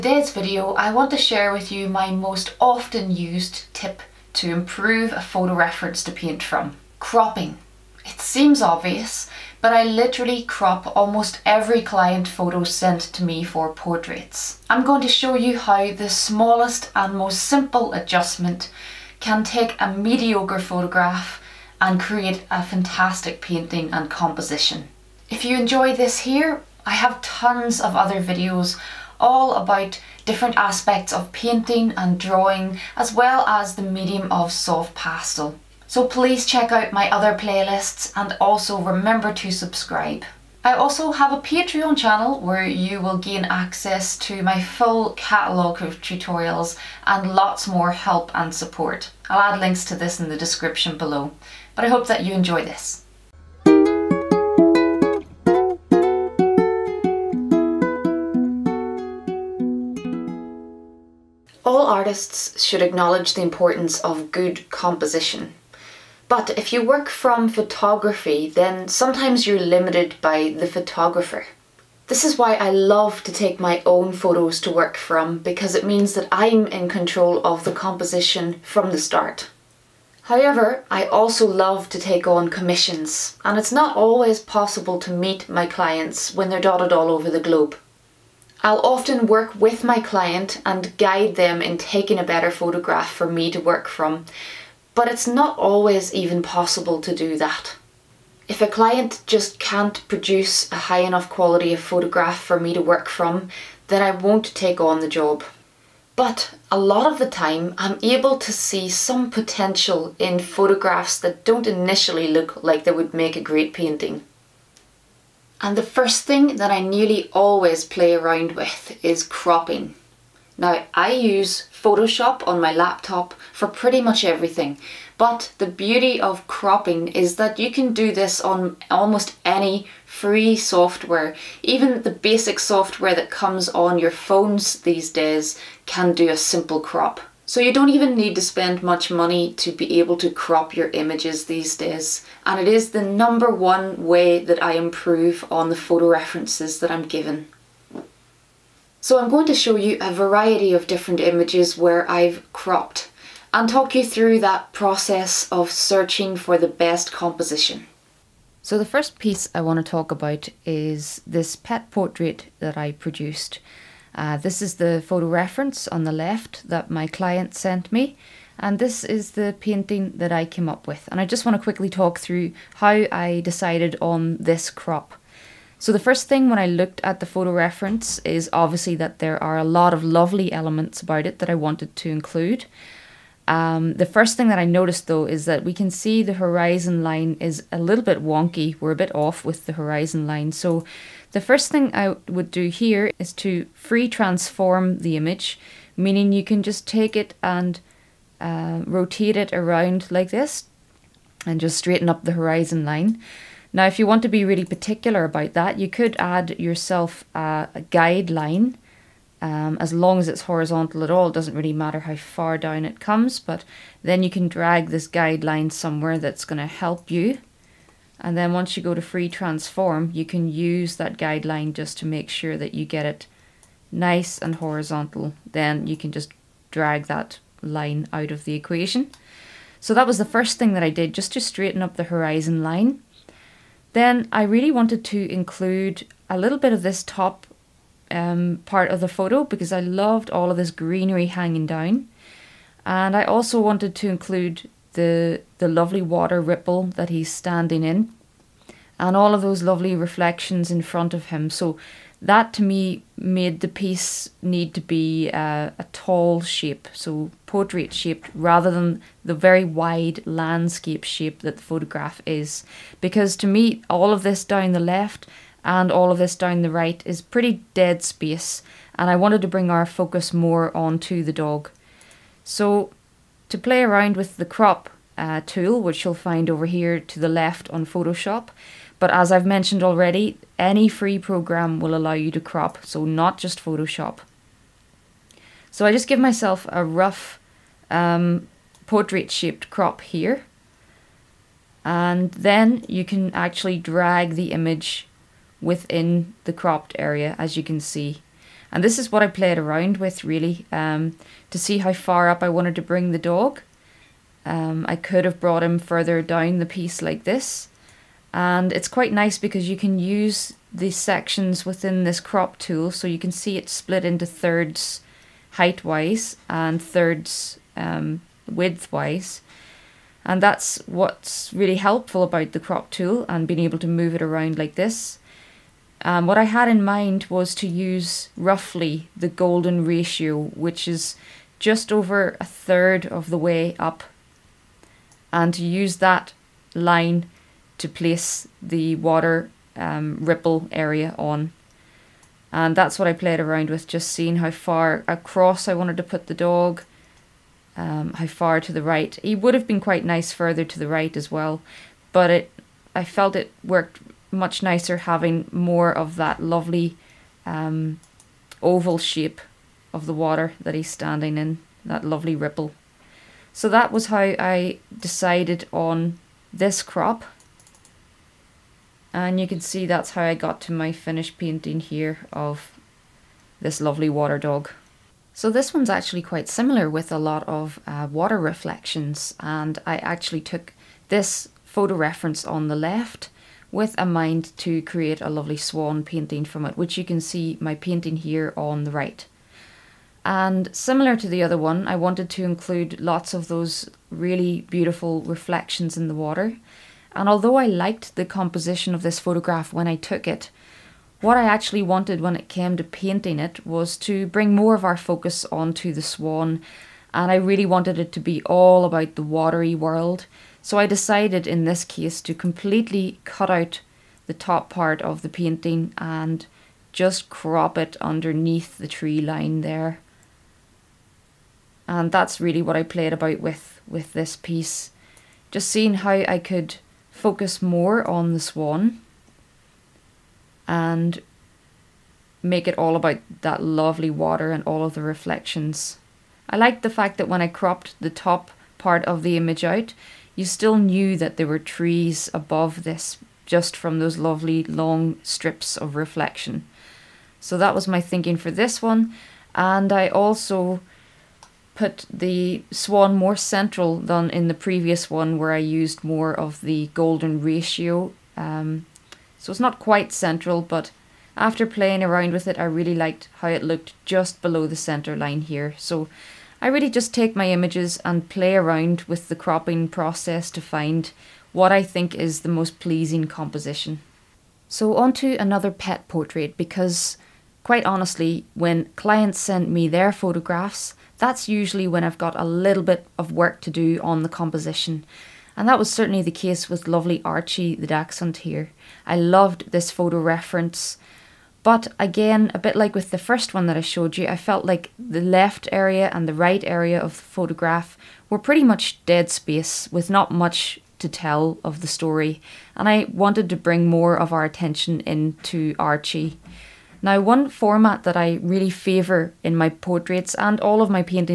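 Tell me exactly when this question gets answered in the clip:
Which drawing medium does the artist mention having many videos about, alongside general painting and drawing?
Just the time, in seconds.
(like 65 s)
34 s.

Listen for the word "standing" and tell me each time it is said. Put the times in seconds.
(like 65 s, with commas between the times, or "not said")
247 s, 360 s.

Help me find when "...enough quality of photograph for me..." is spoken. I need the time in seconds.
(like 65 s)
101 s.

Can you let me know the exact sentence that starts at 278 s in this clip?
But as I've mentioned already, any free program will allow you to crop, so not just Photoshop.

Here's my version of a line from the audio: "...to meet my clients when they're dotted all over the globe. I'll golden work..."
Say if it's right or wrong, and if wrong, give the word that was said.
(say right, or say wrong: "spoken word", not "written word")
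wrong: "often", not "golden".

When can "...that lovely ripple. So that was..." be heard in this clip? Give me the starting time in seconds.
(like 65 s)
361 s.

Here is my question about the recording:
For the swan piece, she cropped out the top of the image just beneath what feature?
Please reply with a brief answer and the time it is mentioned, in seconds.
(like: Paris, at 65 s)
The tree line, at 418 s.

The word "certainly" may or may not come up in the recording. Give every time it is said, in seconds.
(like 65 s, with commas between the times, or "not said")
485 s.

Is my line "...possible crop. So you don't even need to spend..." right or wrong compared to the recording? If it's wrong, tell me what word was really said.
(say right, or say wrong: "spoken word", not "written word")
wrong: "simple", not "possible".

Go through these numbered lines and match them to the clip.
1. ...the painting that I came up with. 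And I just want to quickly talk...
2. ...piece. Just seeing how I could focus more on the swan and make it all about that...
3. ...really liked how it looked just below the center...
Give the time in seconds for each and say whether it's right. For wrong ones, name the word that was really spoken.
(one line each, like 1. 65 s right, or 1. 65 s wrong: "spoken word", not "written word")
1. 169 s right
2. 424 s right
3. 462 s right.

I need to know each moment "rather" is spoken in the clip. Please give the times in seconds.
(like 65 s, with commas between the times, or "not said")
258 s.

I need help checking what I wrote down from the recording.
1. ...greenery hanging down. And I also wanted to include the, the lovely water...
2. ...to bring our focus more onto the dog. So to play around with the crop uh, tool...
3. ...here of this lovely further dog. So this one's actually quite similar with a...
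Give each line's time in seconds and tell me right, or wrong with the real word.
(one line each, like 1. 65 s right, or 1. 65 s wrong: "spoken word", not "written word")
1. 240 s right
2. 269 s right
3. 371 s wrong: "water", not "further".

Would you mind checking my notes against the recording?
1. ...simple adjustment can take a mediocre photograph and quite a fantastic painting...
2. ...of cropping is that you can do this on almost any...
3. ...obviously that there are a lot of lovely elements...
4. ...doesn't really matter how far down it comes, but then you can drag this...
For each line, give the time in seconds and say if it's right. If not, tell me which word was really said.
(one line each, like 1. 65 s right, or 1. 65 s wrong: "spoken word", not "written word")
1. 17 s wrong: "create", not "quite"
2. 126 s right
3. 178 s right
4. 211 s right.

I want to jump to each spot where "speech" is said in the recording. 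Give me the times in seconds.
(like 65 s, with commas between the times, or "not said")
not said.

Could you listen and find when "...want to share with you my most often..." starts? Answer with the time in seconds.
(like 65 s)
0 s.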